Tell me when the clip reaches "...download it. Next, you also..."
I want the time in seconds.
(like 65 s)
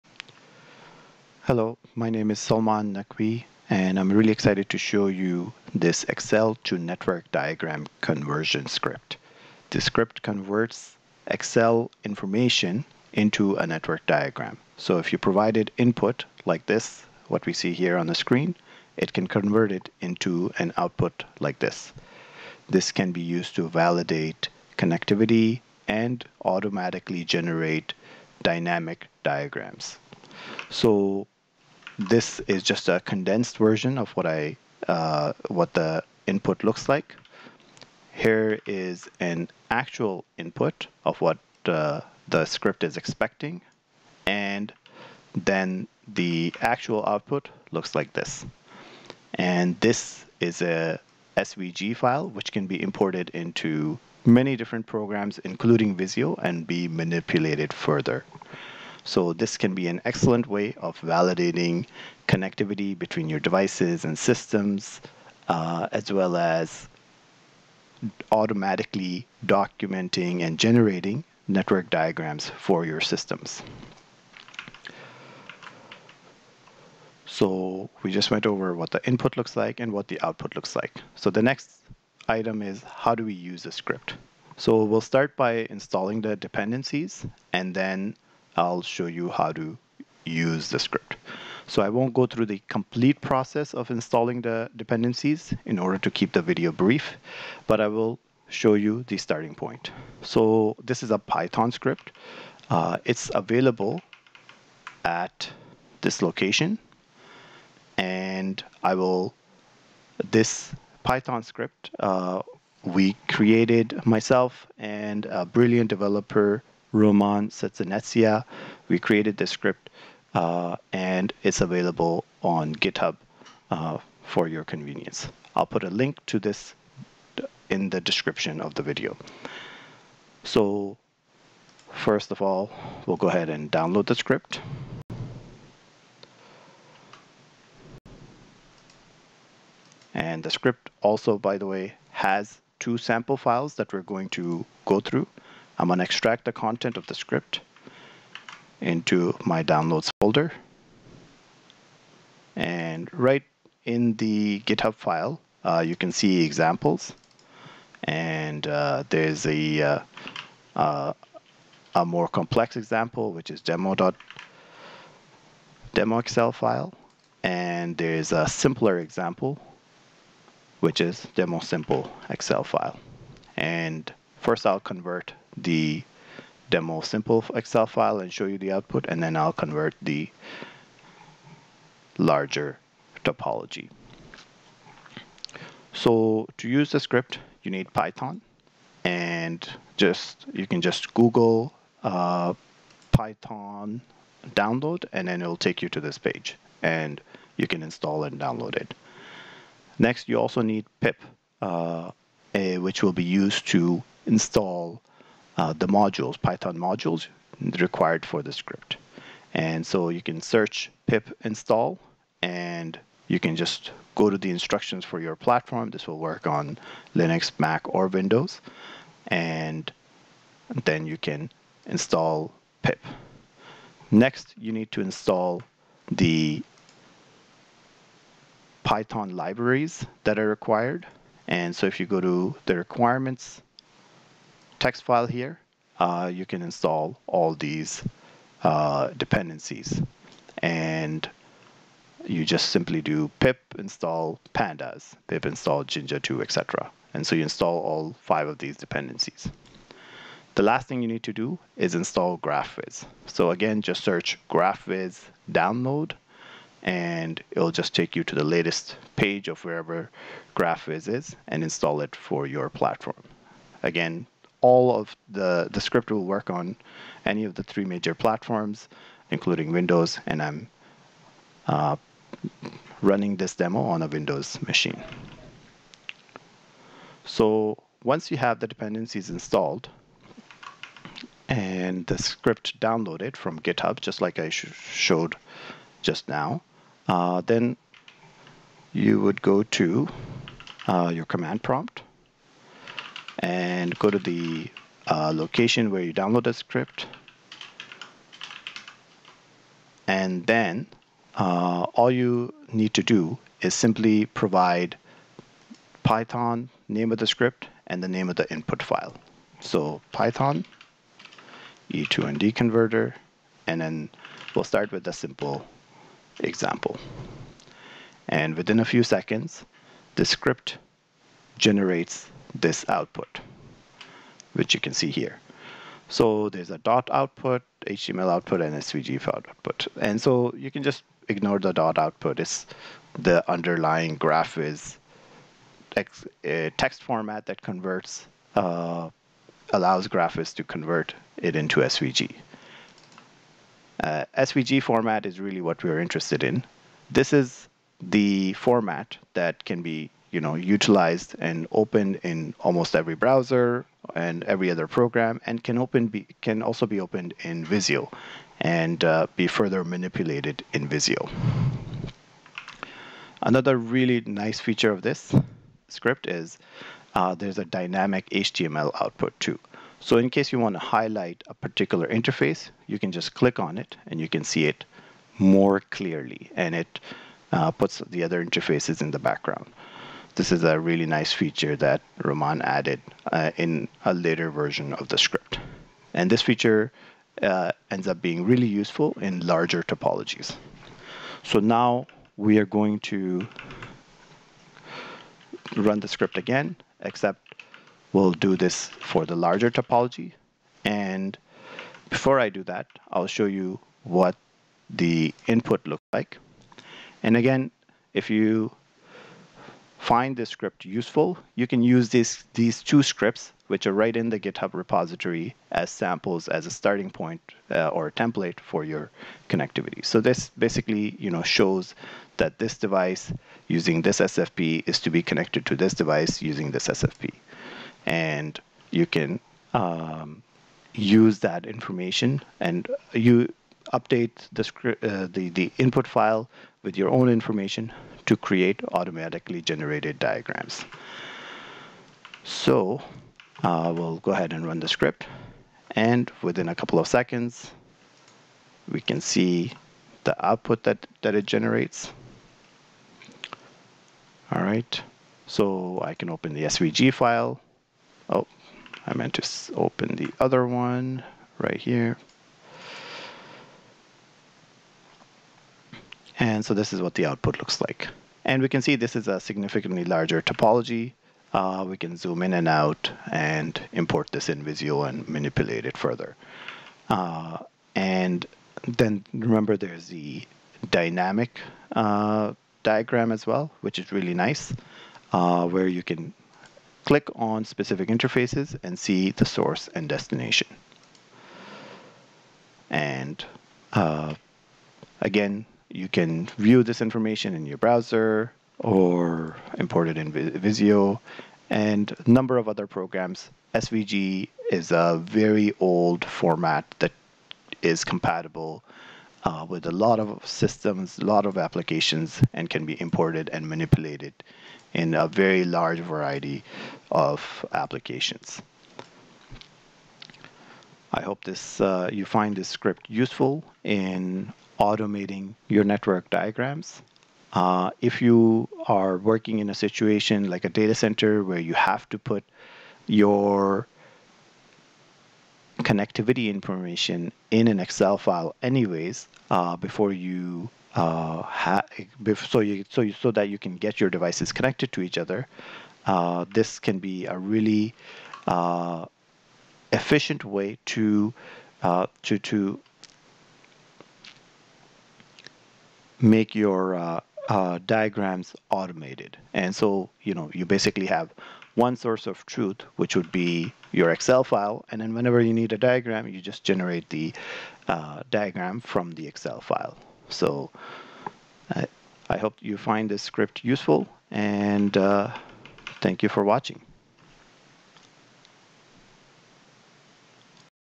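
198 s.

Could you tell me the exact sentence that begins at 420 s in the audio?
So this basically you know, shows that this device using this SFP is to be connected to this device using this SFP.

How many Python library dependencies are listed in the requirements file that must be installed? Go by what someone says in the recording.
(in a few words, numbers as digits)
5.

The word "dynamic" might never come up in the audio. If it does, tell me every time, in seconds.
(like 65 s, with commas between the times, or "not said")
28 s, 367 s, 480 s.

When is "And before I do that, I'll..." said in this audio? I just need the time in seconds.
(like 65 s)
400 s.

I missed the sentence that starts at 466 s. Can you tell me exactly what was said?
And so this is what the output looks like.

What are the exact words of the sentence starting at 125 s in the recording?
I'll put a link to this in the description of the video.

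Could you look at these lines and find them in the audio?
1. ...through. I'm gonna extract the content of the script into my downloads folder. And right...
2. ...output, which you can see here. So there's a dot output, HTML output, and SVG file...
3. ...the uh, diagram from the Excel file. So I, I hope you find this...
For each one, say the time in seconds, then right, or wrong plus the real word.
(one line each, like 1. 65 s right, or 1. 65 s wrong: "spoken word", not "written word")
1. 144 s right
2. 322 s right
3. 567 s right.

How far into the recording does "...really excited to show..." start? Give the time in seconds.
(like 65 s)
4 s.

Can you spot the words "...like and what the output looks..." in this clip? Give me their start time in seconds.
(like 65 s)
79 s.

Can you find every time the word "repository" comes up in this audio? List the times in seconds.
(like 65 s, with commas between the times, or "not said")
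414 s.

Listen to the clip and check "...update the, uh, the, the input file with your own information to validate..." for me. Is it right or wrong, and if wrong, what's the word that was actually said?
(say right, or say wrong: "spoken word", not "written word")
wrong: "create", not "validate".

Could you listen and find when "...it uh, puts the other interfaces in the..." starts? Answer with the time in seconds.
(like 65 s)
376 s.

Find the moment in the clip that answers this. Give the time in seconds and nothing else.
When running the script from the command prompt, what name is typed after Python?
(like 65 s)
311 s.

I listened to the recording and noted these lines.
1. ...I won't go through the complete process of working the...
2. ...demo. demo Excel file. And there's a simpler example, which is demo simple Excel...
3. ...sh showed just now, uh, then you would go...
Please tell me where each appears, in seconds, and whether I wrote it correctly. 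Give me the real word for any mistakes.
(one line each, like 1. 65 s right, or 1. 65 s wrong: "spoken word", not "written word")
1. 91 s wrong: "installing", not "working"
2. 163 s right
3. 284 s right.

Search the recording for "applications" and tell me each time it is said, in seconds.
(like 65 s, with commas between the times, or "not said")
511 s, 517 s.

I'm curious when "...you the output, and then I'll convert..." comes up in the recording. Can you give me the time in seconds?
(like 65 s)
178 s.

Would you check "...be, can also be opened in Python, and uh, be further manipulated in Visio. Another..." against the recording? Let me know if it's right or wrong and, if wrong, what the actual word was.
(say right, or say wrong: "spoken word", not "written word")
wrong: "Visio", not "Python".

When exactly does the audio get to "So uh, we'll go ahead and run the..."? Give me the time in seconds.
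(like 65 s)
442 s.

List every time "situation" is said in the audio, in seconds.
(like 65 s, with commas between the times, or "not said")
529 s.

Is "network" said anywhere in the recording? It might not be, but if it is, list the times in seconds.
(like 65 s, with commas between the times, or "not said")
6 s, 13 s, 71 s, 525 s.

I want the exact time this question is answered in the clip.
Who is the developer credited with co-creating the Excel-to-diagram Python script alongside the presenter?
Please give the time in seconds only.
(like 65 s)
116 s.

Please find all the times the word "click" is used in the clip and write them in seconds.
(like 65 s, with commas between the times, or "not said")
373 s, 487 s.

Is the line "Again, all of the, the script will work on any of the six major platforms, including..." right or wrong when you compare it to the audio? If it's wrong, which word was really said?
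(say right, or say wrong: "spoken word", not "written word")
wrong: "three", not "six".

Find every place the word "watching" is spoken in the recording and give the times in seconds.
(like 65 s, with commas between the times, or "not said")
576 s.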